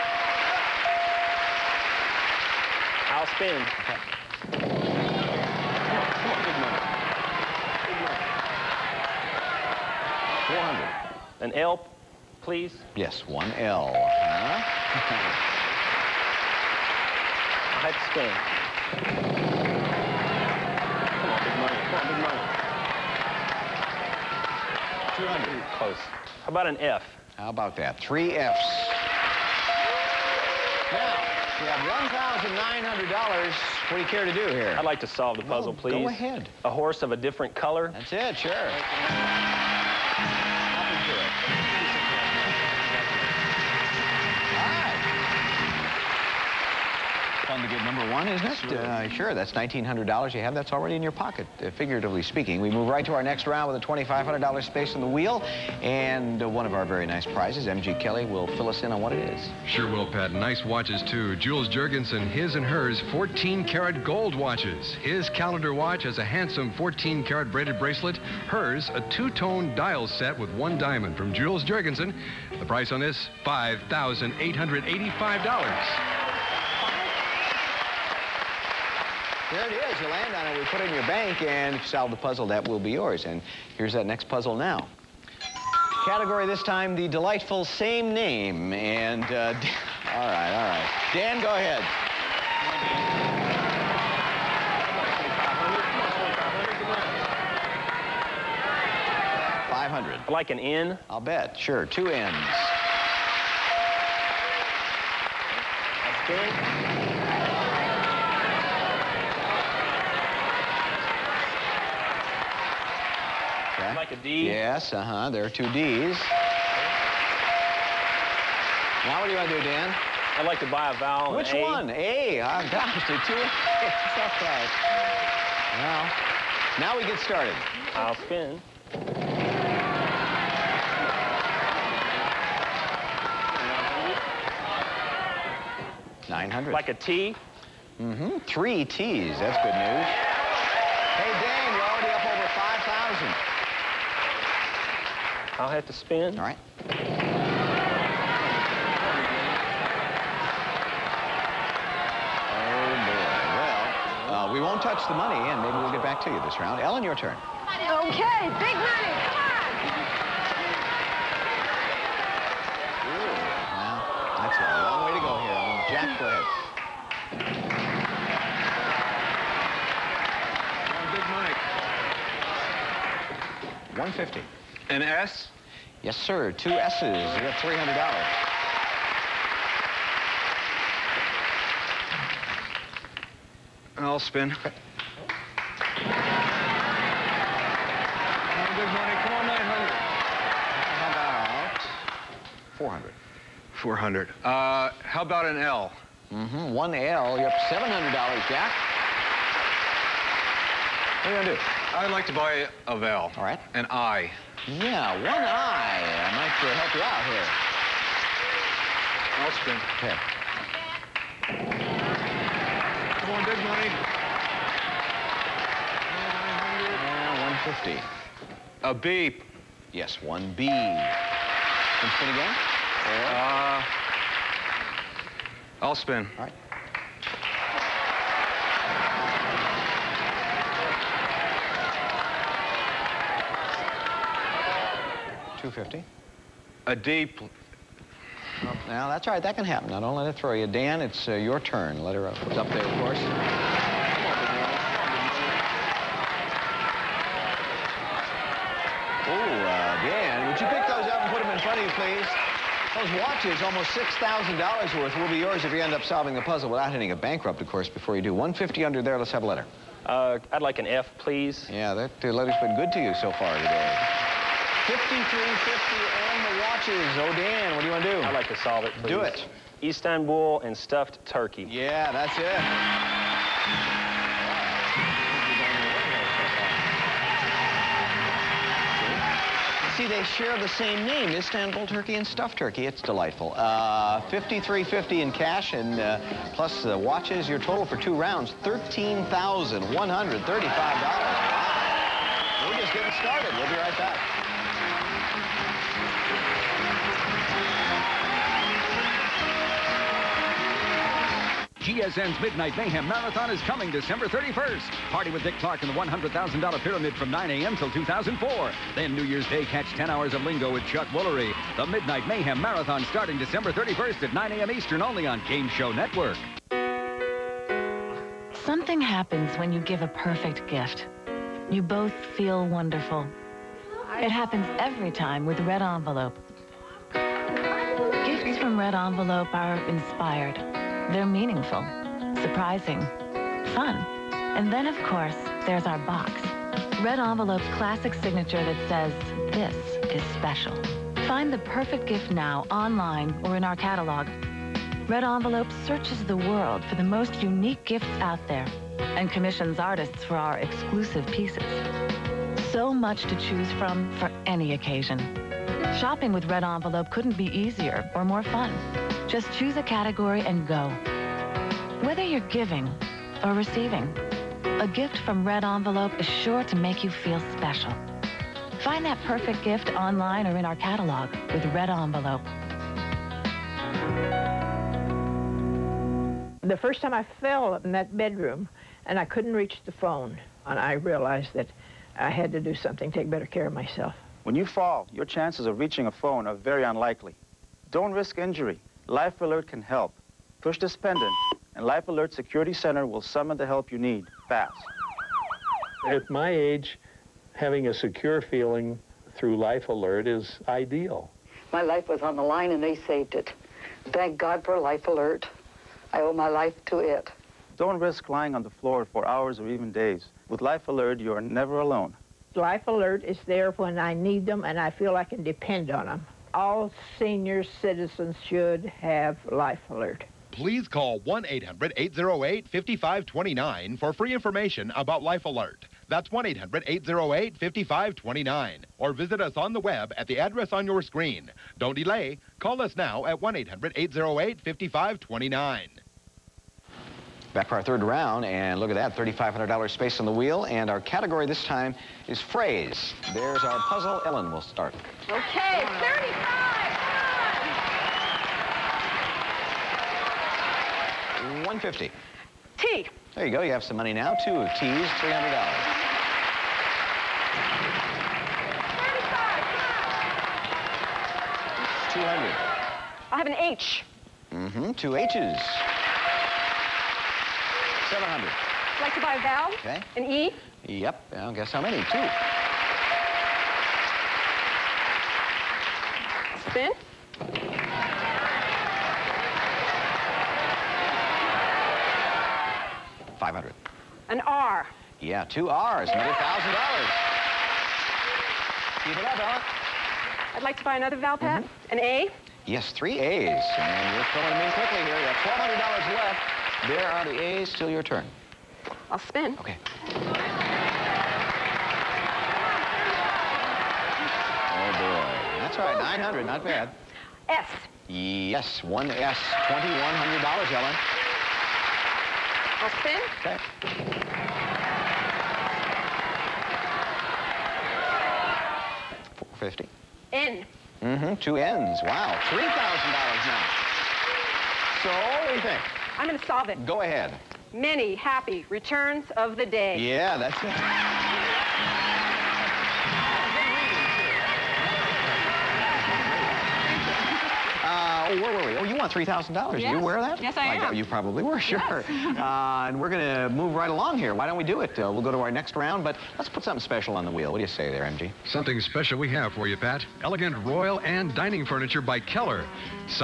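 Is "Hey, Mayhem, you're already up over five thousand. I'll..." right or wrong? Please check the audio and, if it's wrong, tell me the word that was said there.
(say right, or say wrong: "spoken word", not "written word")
wrong: "Dan", not "Mayhem".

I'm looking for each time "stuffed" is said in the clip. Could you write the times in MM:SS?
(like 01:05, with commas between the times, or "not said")
04:30, 04:42.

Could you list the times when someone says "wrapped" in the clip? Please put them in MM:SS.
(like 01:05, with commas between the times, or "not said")
not said.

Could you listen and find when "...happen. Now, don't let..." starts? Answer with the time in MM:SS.
03:59.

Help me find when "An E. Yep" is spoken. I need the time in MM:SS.
07:50.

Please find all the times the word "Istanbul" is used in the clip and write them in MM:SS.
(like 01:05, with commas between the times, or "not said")
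04:29, 04:41.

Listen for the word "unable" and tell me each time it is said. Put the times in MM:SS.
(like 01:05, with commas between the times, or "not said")
not said.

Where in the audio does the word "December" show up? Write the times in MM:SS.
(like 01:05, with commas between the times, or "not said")
05:03, 05:13.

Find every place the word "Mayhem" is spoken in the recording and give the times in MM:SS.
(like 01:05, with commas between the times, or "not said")
05:02, 05:12.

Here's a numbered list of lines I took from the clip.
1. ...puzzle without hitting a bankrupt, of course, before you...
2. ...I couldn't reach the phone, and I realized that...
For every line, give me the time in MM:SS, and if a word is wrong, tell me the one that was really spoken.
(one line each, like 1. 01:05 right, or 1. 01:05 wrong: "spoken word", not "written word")
1. 04:16 right
2. 06:19 right.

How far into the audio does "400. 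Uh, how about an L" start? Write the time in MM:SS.
03:13.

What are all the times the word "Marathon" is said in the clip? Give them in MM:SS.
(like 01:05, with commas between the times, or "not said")
05:03, 05:12.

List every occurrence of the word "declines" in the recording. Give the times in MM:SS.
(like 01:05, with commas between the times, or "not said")
not said.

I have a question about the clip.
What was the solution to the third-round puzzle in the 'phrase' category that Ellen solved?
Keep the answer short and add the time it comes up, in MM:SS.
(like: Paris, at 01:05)
Many happy returns of the day, at 08:47.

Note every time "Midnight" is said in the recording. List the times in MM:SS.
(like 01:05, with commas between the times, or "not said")
05:02, 05:11.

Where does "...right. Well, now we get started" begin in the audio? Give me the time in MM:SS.
02:04.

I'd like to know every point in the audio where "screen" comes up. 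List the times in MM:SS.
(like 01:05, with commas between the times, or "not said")
07:11.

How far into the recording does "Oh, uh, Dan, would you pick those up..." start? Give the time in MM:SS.
04:09.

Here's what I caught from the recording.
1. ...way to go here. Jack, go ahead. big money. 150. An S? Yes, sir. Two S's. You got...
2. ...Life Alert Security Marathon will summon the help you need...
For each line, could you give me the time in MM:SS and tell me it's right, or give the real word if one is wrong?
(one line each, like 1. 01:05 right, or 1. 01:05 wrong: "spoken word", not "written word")
1. 02:45 right
2. 06:31 wrong: "Center", not "Marathon".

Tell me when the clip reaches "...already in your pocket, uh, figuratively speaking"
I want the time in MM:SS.
00:50.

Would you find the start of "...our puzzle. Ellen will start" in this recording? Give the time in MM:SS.
07:23.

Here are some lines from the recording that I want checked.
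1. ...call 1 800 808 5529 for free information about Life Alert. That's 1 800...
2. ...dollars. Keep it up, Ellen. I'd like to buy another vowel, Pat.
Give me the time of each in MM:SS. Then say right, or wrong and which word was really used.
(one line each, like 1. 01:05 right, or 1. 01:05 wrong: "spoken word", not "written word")
1. 07:00 right
2. 08:06 right.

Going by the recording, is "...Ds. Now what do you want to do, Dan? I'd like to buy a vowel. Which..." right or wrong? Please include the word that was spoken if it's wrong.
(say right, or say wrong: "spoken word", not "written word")
right.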